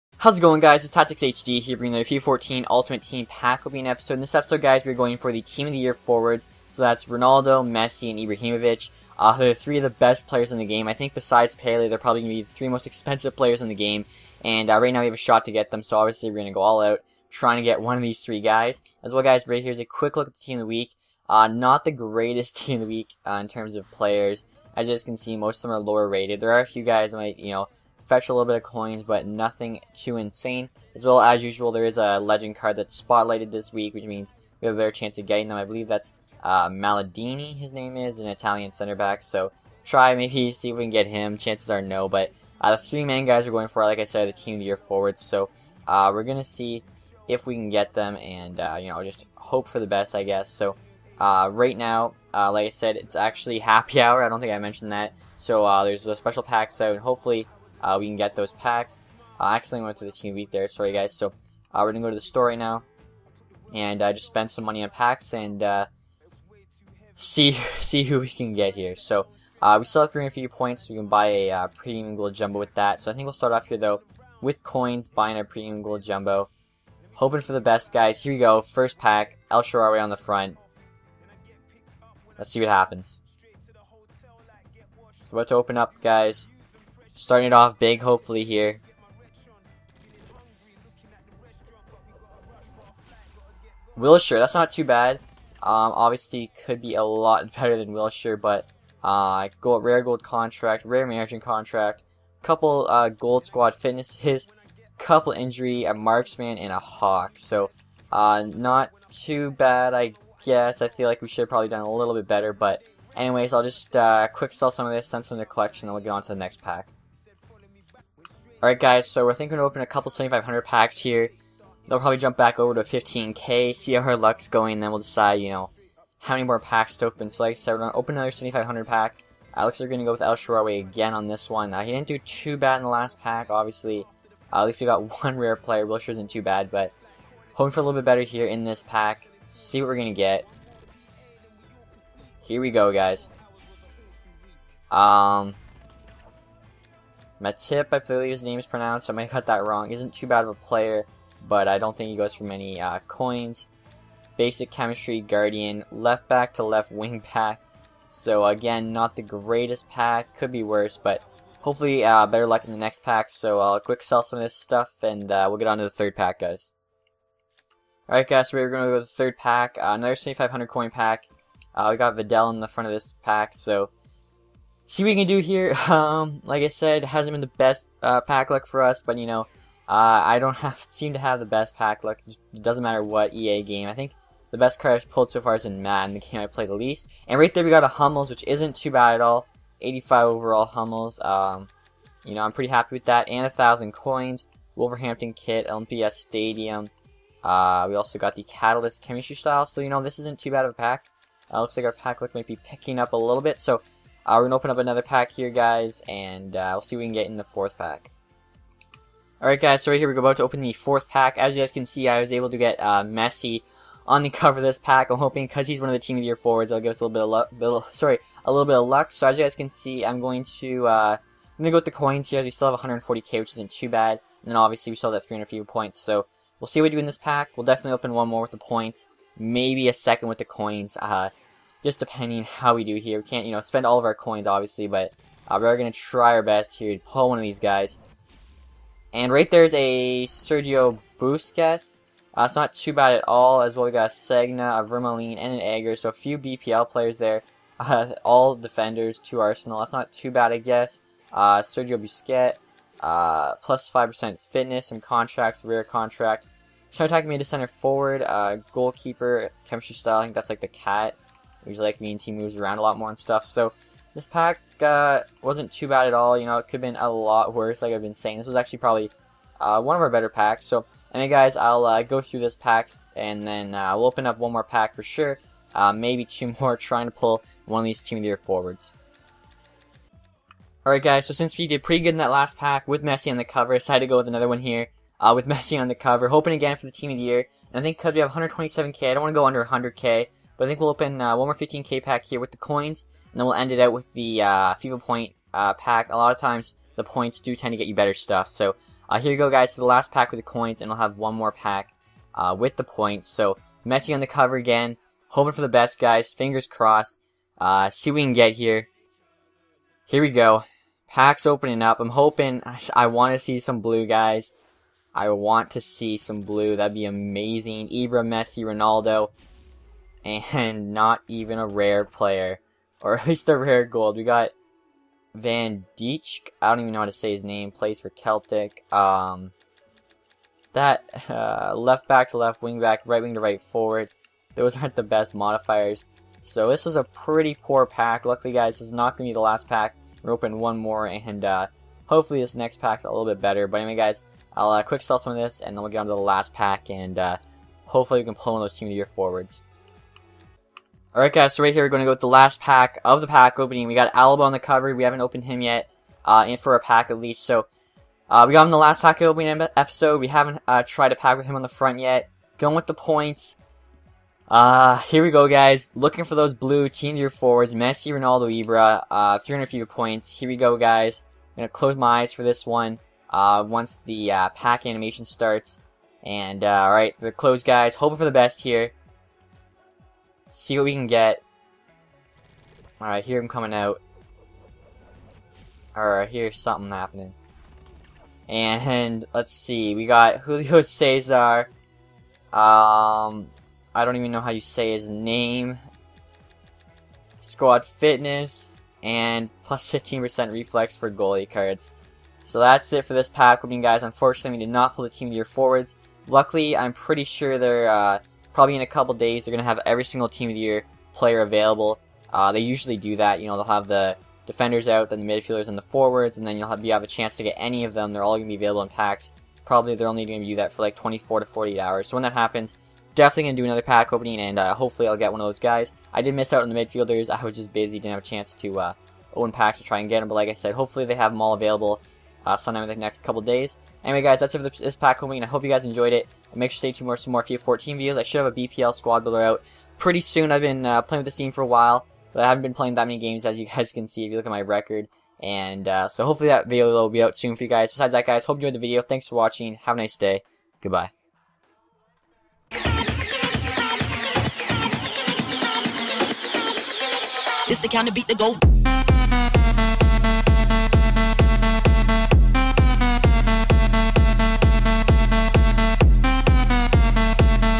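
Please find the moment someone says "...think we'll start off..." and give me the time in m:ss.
1:13.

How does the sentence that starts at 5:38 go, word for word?
Luckily, guys, this is not going to be the last pack.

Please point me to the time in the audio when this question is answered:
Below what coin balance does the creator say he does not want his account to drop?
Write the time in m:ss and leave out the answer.
4:49.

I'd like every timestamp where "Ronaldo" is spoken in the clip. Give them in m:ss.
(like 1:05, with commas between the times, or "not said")
0:07, 5:18, 6:08.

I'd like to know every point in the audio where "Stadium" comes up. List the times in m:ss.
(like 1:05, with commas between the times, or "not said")
3:16.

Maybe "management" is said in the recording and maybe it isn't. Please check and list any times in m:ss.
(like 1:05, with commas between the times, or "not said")
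1:41.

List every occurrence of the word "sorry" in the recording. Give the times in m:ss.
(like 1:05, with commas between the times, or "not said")
1:00, 3:37.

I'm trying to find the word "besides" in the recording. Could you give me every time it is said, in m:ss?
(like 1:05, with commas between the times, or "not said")
0:11, 7:27.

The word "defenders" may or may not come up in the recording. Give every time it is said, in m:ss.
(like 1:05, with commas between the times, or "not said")
4:08, 6:54.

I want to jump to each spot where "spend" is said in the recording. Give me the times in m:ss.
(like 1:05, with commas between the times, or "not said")
1:04, 3:53.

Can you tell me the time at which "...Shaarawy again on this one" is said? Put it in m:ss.
2:10.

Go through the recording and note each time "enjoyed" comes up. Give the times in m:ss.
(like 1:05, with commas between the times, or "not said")
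7:15, 7:28.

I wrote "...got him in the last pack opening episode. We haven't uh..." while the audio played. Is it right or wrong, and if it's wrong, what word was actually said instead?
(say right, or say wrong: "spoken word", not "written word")
right.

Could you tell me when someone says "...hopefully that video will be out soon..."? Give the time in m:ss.
7:26.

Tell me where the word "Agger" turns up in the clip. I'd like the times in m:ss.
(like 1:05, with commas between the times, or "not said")
4:05.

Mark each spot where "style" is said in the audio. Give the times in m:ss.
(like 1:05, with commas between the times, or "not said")
3:19, 4:19.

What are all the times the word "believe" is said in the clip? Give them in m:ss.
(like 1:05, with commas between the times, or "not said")
0:35, 2:27.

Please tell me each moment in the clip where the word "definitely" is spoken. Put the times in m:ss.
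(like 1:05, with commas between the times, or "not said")
3:47, 7:03.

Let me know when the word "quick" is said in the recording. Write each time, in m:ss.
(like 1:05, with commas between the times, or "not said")
0:19, 1:54, 2:43, 5:44.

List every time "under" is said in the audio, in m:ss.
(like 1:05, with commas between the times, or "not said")
4:49.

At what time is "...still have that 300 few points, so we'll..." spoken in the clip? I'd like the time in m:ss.
3:44.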